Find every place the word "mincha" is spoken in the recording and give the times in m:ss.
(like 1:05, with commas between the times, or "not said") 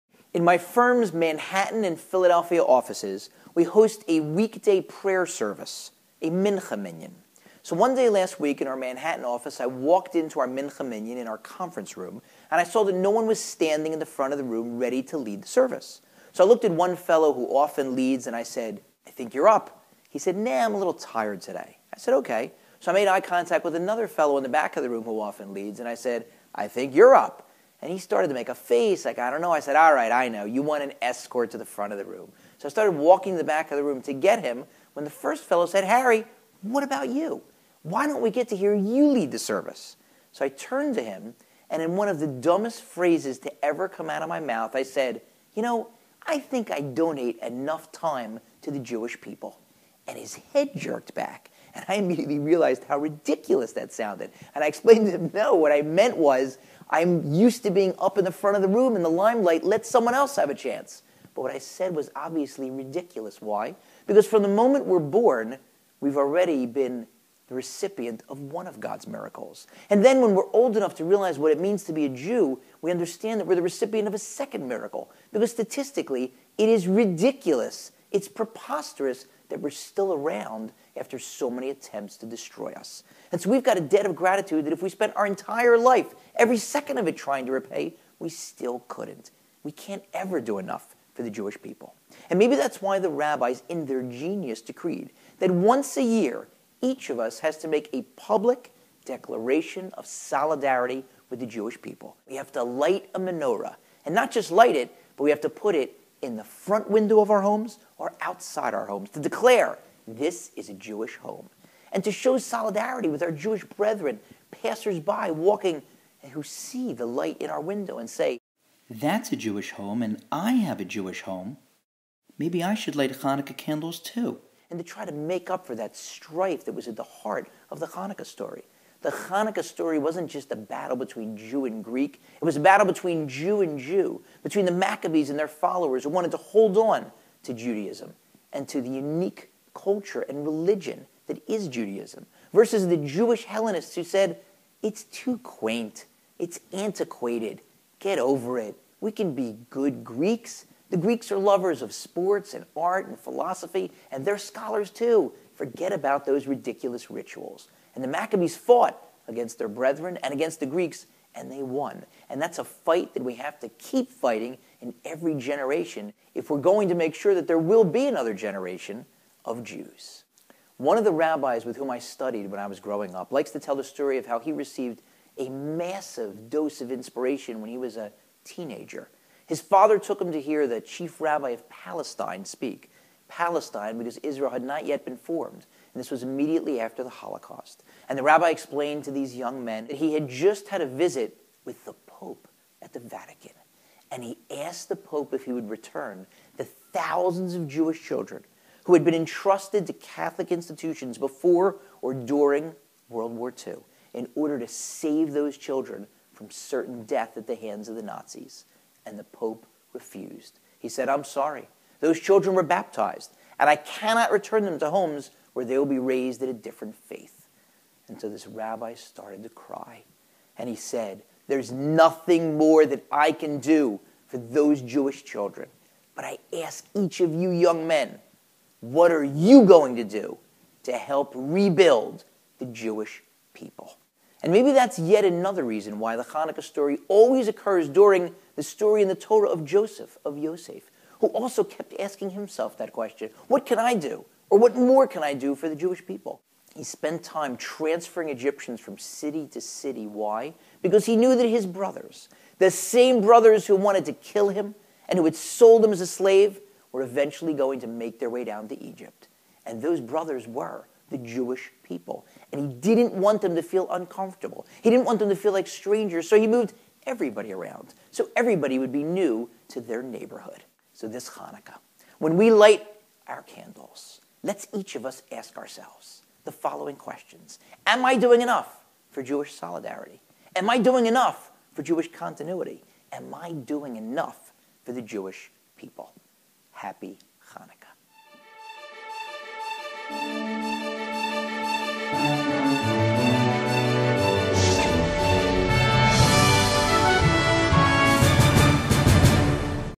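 0:06, 0:10.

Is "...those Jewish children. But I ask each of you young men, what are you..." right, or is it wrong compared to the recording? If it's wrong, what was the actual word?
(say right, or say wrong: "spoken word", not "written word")
right.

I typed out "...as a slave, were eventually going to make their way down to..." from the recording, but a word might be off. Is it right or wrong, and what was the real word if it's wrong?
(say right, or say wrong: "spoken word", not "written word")
right.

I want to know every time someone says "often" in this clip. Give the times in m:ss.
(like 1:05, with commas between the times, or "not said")
0:17, 0:25.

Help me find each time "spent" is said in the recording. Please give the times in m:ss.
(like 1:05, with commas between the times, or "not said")
1:24, 4:06.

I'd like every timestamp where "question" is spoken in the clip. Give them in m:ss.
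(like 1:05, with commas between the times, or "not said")
4:02, 4:36.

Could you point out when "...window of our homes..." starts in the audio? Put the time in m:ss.
1:46.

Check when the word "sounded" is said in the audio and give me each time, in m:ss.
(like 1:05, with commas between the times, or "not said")
0:53.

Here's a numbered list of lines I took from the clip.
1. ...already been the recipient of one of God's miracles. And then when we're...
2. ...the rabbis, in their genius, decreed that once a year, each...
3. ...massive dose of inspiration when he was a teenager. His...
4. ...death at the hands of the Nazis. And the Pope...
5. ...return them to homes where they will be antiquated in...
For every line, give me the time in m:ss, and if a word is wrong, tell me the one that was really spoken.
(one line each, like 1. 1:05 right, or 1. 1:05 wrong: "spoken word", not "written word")
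1. 1:06 right
2. 1:32 right
3. 2:55 right
4. 3:27 right
5. 3:34 wrong: "raised", not "antiquated".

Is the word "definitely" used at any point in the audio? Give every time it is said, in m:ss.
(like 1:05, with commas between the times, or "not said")
not said.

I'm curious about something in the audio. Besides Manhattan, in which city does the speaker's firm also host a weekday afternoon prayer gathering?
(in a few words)
Philadelphia.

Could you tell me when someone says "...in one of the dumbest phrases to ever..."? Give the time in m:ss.
0:41.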